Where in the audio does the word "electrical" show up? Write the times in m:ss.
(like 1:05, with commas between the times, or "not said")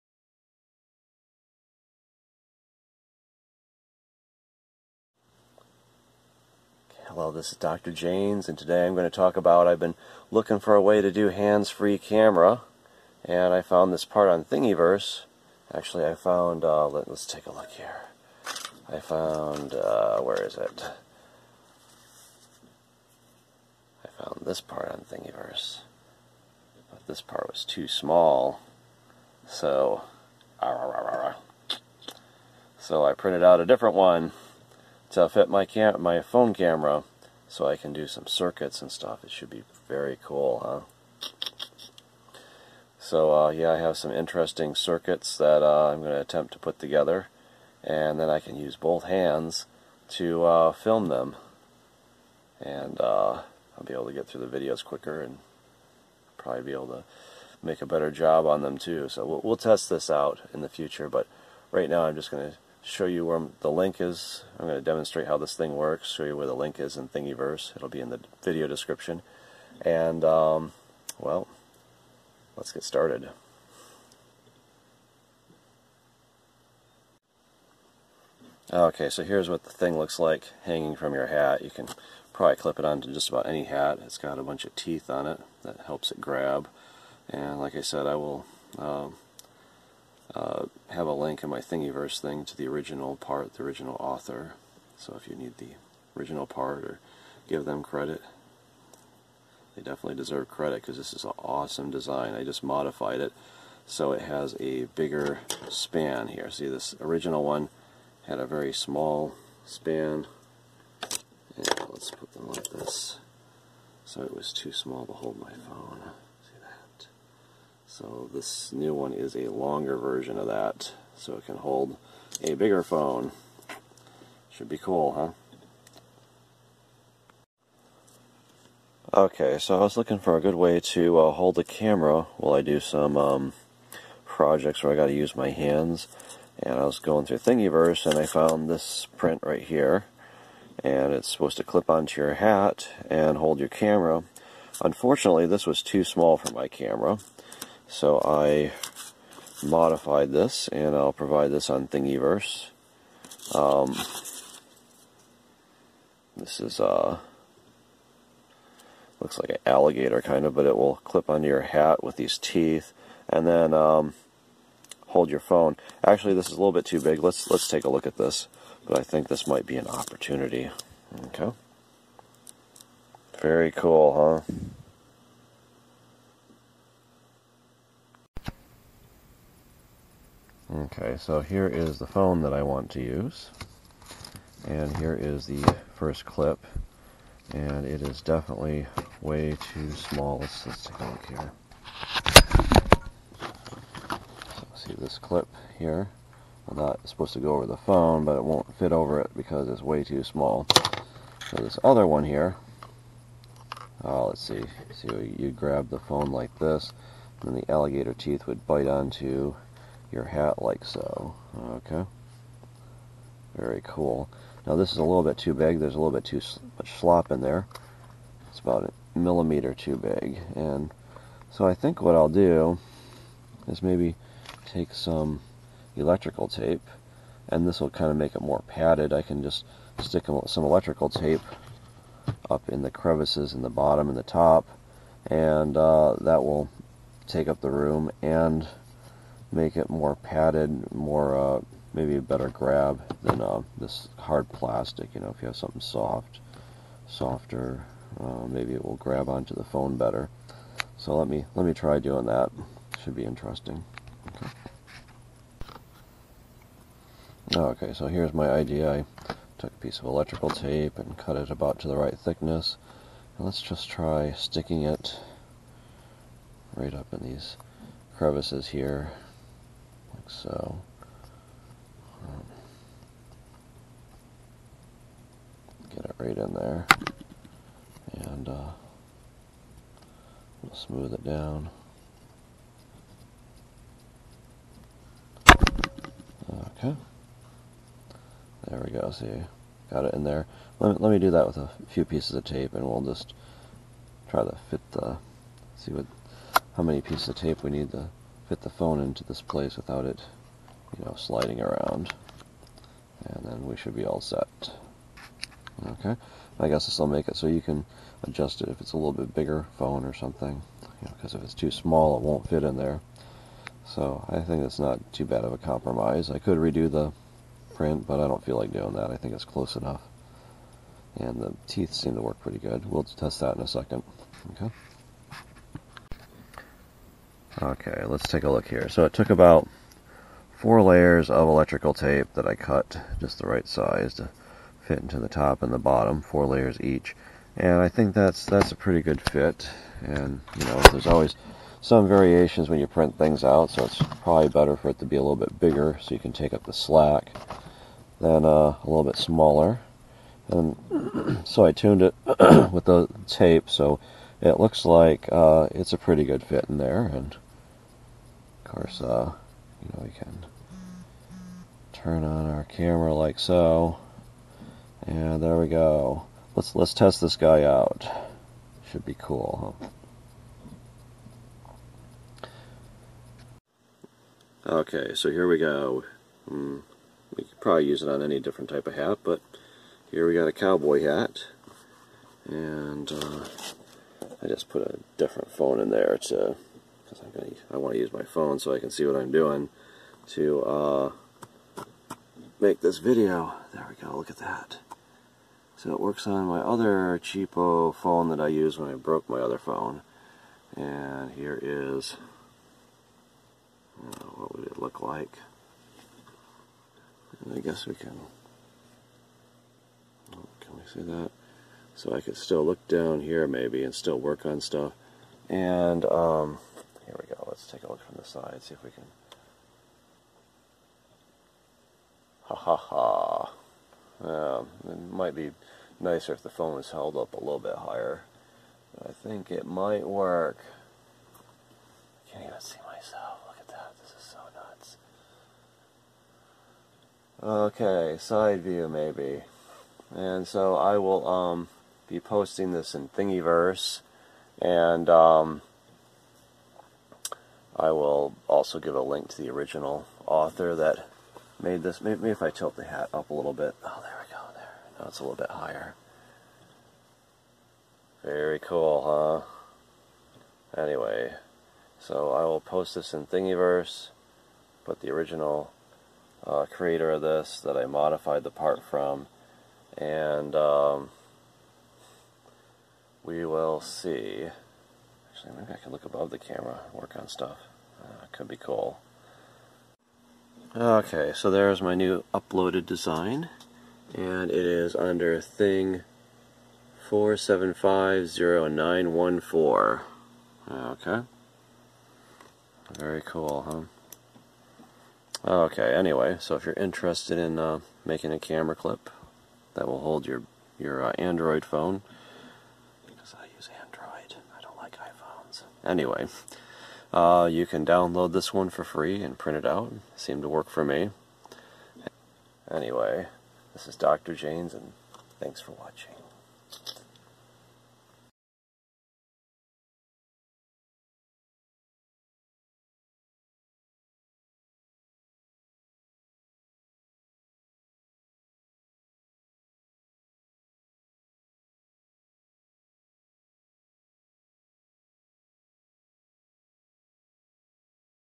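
3:45, 3:50, 4:20, 5:31.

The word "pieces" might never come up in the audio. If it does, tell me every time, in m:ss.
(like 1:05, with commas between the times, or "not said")
4:19, 4:52, 4:57.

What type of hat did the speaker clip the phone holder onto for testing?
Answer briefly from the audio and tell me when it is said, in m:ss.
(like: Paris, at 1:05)
cowboy hat, at 6:20.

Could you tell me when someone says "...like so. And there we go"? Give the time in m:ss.
6:03.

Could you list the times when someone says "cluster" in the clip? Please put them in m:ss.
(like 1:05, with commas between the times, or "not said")
not said.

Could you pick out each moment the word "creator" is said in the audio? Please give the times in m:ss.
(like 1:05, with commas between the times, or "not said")
7:46.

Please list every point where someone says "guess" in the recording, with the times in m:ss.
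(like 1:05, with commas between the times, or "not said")
5:06, 6:47.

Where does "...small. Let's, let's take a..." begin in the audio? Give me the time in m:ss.
3:09.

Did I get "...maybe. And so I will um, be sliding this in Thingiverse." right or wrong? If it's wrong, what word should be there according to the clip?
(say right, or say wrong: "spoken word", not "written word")
wrong: "posting", not "sliding".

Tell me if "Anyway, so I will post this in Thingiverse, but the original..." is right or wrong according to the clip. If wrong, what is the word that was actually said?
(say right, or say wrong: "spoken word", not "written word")
right.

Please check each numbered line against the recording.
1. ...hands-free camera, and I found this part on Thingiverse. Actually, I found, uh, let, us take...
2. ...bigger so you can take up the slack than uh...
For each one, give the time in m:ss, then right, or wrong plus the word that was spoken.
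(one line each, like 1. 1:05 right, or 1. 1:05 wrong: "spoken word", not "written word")
1. 0:11 right
2. 5:45 right.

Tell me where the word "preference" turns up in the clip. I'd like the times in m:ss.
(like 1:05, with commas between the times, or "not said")
not said.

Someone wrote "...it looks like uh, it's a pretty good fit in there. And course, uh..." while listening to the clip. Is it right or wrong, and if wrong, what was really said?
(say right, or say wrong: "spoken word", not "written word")
right.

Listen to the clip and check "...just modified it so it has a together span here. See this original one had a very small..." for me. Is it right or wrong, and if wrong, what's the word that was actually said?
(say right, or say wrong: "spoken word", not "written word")
wrong: "bigger", not "together".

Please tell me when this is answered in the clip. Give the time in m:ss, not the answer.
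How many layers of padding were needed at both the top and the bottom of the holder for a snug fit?
5:36.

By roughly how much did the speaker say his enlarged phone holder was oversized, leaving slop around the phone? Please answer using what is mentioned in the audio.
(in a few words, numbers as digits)
1 millimeter.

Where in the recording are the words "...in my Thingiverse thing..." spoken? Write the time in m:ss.
1:31.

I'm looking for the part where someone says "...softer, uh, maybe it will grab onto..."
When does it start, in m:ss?
4:07.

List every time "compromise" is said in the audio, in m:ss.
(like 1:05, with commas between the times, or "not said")
5:15.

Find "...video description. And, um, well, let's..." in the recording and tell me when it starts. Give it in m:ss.
1:08.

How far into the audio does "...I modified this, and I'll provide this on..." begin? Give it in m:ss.
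2:28.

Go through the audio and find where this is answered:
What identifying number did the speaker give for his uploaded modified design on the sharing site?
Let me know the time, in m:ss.
8:05.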